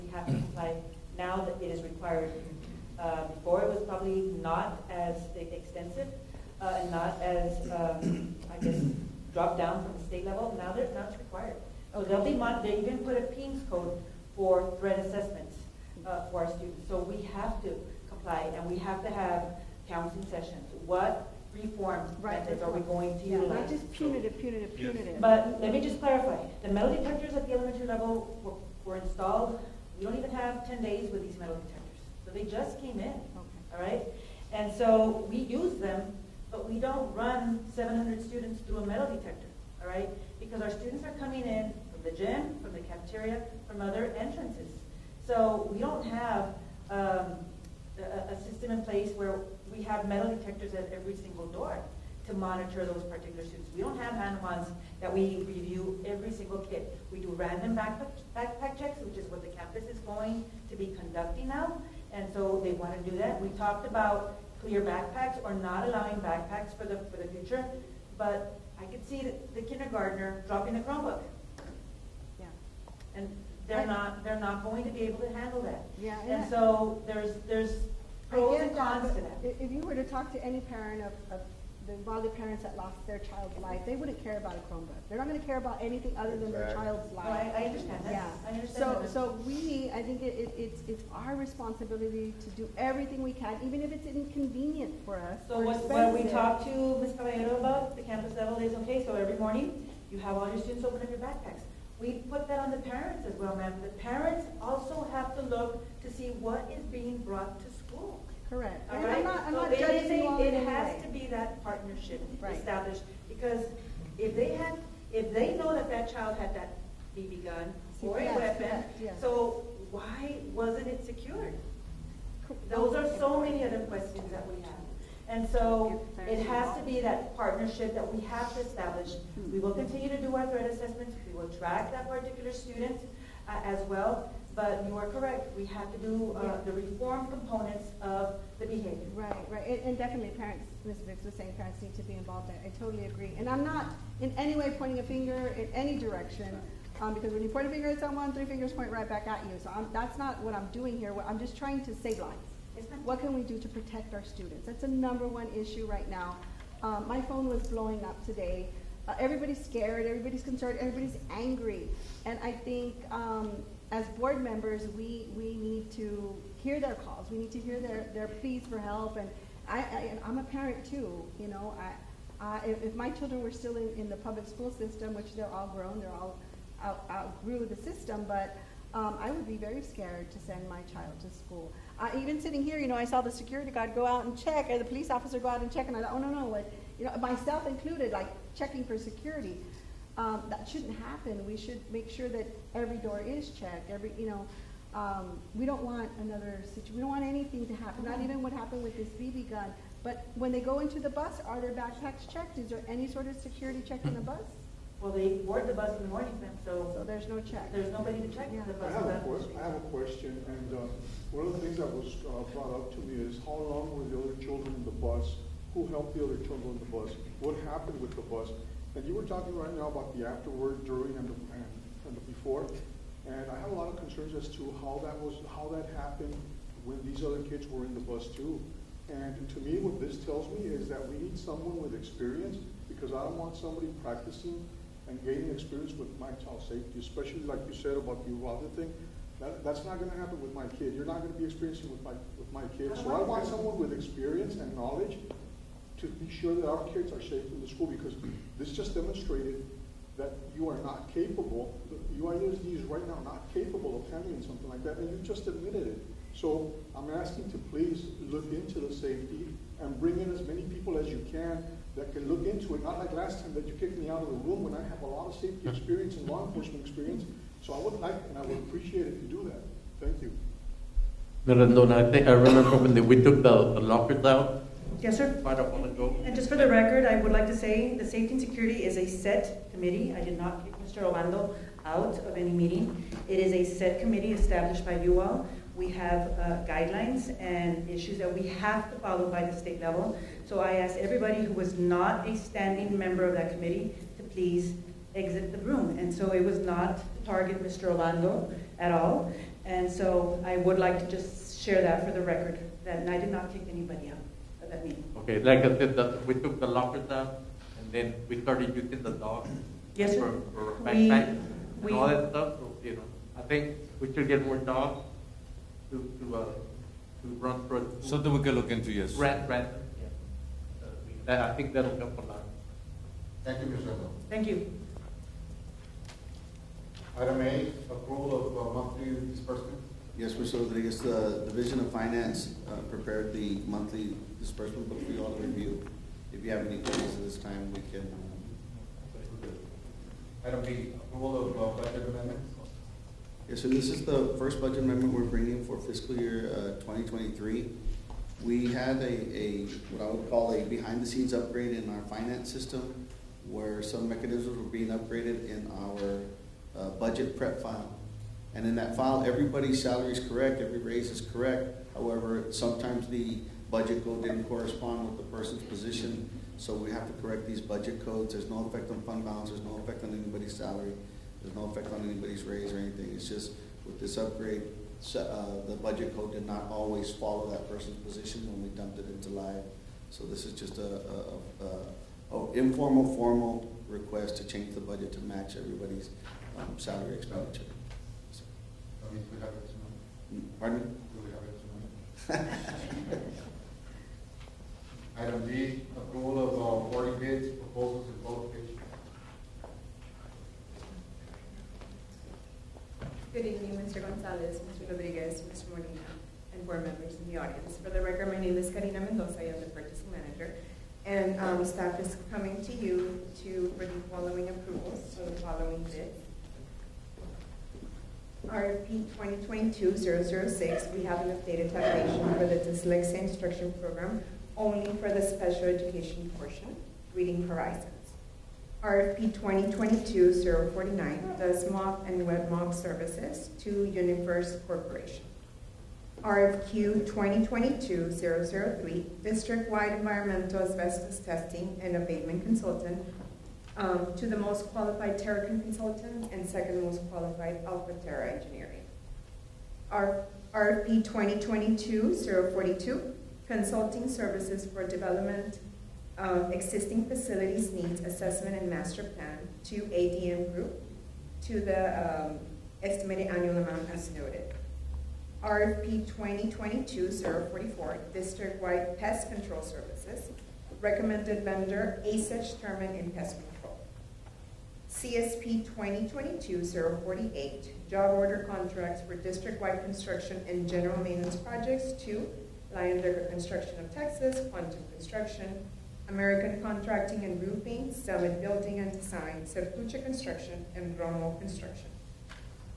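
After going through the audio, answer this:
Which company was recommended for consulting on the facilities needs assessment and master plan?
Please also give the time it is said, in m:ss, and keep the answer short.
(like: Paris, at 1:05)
ADM group, at 7:39.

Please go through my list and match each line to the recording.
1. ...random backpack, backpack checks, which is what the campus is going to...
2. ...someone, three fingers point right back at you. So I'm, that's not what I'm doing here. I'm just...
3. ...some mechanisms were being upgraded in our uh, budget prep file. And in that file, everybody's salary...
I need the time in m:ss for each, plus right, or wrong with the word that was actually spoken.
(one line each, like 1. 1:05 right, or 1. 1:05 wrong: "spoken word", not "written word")
1. 0:57 right
2. 2:27 right
3. 5:53 right.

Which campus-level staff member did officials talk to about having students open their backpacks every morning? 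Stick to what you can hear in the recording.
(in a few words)
Ms. Caballero.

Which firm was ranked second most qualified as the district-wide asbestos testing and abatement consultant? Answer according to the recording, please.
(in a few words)
Alpha Terra engineering.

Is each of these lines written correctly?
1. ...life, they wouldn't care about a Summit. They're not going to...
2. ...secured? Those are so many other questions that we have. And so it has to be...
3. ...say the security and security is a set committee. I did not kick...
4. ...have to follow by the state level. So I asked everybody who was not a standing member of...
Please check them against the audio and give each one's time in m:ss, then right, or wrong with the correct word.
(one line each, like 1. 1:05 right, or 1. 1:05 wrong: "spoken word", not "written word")
1. 1:23 wrong: "Chromebook", not "Summit"
2. 2:01 right
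3. 4:37 wrong: "safety", not "security"
4. 4:48 right.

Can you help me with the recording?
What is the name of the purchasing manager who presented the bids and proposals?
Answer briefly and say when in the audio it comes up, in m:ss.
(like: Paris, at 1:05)
Karina Mendoza, at 6:48.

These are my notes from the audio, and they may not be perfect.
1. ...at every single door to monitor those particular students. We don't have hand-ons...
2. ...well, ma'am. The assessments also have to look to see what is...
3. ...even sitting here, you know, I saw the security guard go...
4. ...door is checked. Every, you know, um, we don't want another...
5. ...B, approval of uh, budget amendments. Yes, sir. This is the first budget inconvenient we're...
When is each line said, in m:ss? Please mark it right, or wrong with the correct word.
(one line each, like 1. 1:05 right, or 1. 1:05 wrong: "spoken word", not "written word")
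1. 0:50 right
2. 1:43 wrong: "parents", not "assessments"
3. 3:02 right
4. 3:12 right
5. 5:40 wrong: "amendment", not "inconvenient".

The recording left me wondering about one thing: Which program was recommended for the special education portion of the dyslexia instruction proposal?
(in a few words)
Reading Horizon.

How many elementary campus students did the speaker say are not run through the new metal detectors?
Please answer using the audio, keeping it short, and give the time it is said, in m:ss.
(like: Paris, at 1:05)
700, at 0:37.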